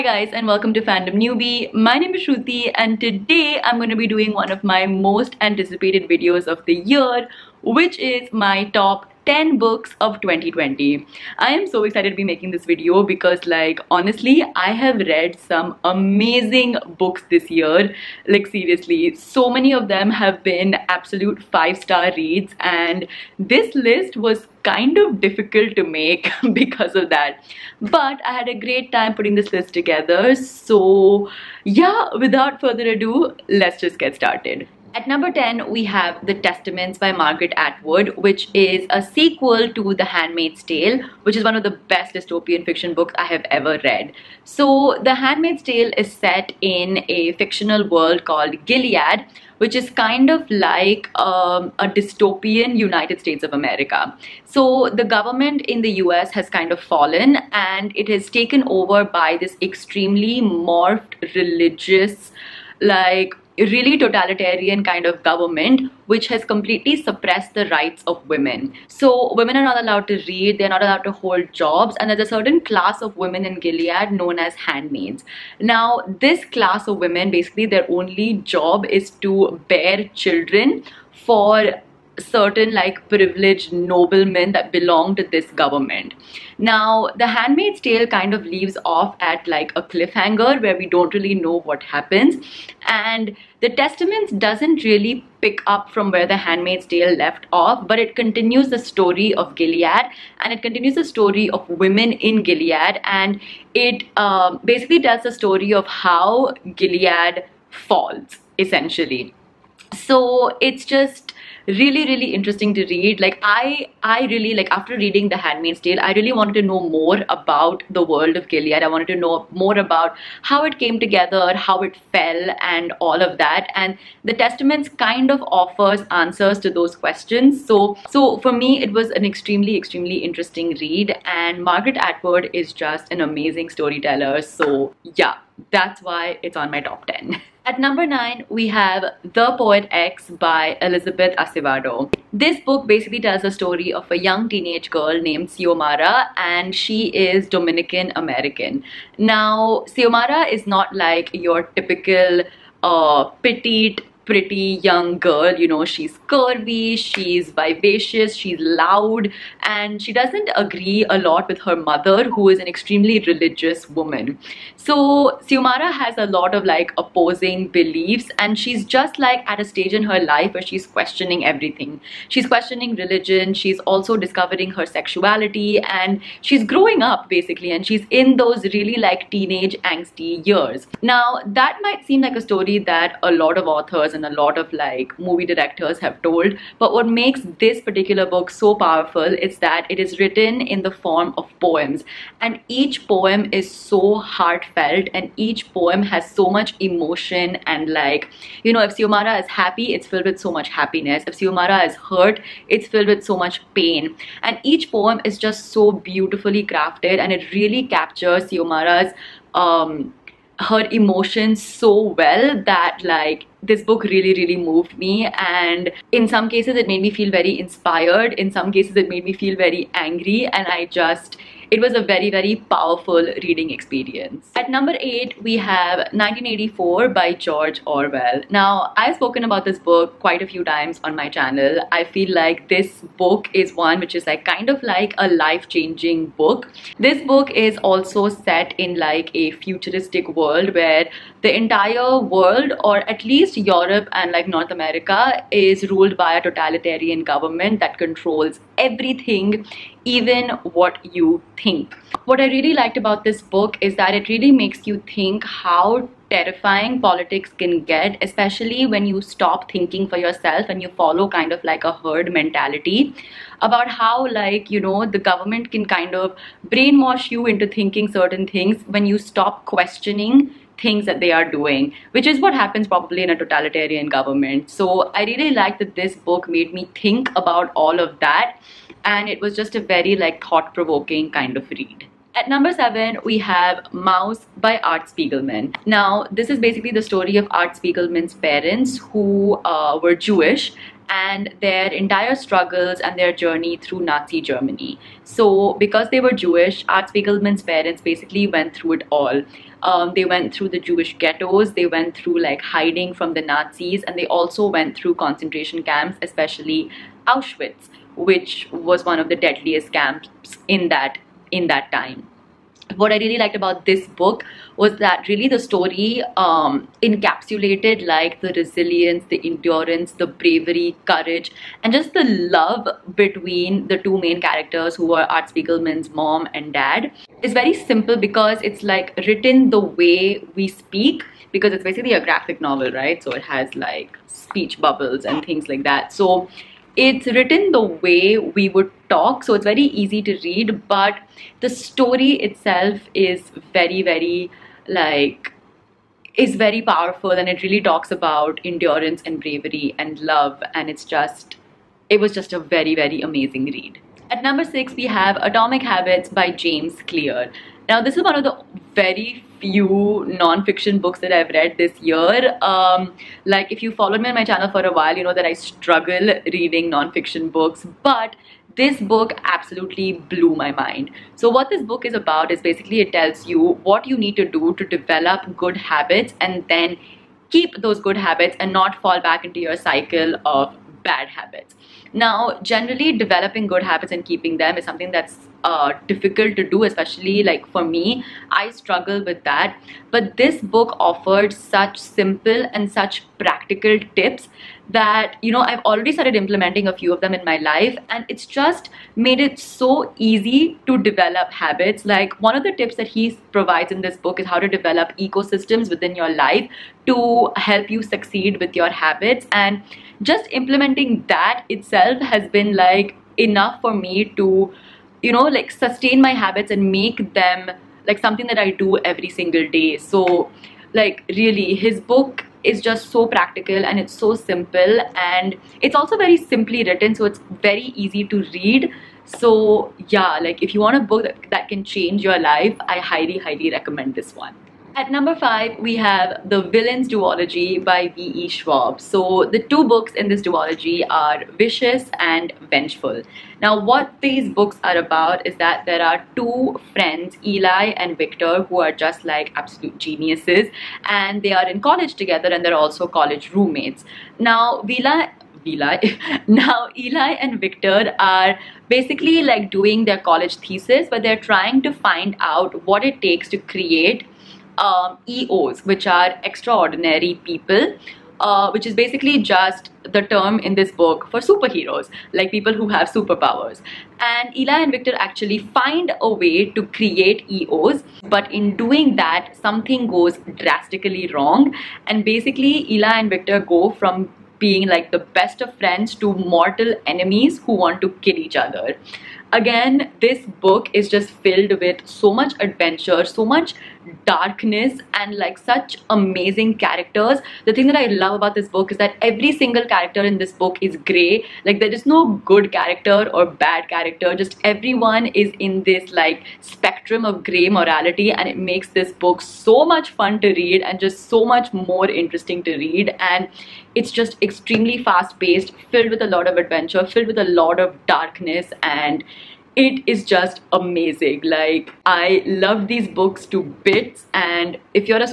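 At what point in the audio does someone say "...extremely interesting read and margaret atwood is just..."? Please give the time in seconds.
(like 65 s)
129 s.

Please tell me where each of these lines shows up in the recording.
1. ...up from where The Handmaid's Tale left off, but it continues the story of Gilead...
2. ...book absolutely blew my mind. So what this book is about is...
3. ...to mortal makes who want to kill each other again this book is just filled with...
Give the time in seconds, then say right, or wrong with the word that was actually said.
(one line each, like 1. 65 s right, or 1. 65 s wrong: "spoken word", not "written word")
1. 95 s right
2. 369 s right
3. 486 s wrong: "enemies", not "makes".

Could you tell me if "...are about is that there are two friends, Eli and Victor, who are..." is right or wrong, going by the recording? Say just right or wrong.
right.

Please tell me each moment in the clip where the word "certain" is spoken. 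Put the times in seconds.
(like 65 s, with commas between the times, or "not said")
72 s, 82 s, 268 s.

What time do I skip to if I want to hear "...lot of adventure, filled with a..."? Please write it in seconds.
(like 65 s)
516 s.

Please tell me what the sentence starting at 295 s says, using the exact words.
So, because they were Jewish, Art Spiegelman's parents basically went through it all.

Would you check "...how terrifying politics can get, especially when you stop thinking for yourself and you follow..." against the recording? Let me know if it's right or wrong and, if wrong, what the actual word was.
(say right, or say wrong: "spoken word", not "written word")
right.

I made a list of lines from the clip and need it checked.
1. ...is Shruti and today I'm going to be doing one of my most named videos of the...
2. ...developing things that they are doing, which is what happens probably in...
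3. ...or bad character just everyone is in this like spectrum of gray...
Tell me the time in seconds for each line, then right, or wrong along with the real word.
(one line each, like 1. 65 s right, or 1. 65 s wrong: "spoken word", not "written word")
1. 2 s wrong: "anticipated", not "named"
2. 269 s wrong: "questioning", not "developing"
3. 503 s right.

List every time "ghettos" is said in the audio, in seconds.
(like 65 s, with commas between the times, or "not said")
301 s.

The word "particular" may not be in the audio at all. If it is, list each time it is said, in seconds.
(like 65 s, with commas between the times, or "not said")
187 s.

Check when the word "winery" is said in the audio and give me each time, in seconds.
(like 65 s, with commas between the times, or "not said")
not said.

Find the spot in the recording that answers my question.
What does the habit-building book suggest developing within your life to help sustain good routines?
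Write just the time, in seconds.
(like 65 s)
405 s.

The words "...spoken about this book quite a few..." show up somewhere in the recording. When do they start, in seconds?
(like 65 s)
229 s.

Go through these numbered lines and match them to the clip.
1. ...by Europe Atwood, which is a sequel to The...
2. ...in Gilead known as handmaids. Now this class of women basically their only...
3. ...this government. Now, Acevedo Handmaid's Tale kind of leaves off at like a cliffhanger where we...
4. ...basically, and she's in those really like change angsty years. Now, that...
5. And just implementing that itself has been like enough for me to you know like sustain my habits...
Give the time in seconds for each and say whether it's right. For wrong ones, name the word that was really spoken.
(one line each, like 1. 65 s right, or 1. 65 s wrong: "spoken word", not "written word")
1. 36 s wrong: "Margaret", not "Europe"
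2. 73 s right
3. 85 s wrong: "The", not "Acevedo"
4. 177 s wrong: "teenage", not "change"
5. 409 s right.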